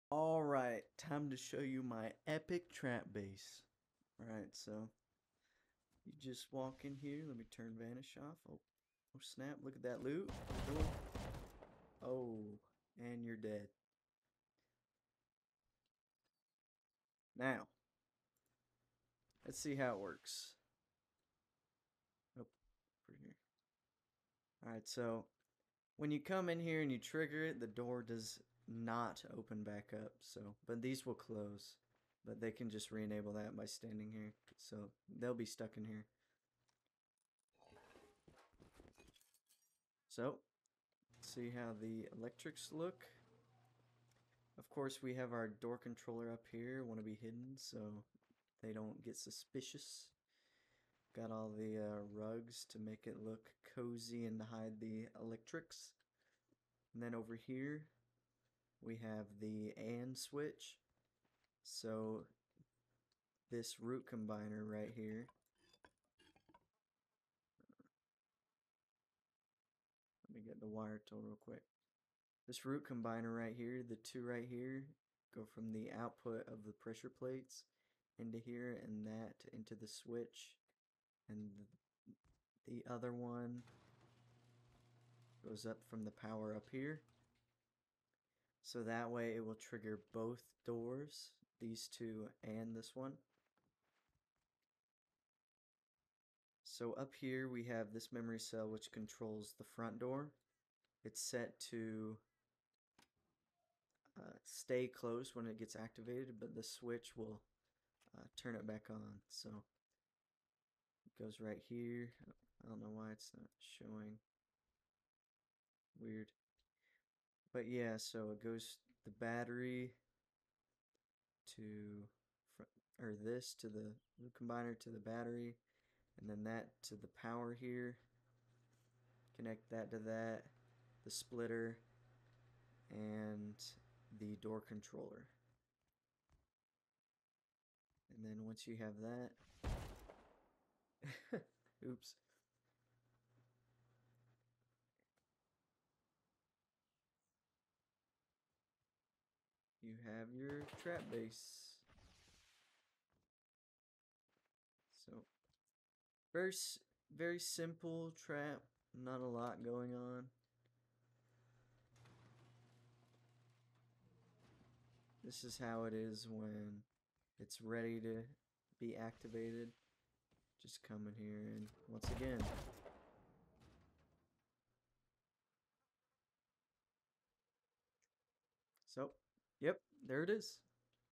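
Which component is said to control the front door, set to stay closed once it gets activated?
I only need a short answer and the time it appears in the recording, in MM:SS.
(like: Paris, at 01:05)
Memory cell, at 01:38.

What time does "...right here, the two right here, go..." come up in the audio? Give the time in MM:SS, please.
01:13.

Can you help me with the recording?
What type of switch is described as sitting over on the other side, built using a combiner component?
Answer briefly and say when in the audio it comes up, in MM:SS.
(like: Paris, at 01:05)
AND switch, at 00:59.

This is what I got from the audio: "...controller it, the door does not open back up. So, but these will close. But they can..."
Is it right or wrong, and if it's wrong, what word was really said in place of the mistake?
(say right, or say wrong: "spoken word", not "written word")
wrong: "trigger", not "controller".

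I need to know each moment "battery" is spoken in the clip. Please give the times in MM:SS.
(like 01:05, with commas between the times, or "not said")
01:59, 02:04.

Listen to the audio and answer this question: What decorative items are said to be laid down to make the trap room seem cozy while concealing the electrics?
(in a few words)
Rugs.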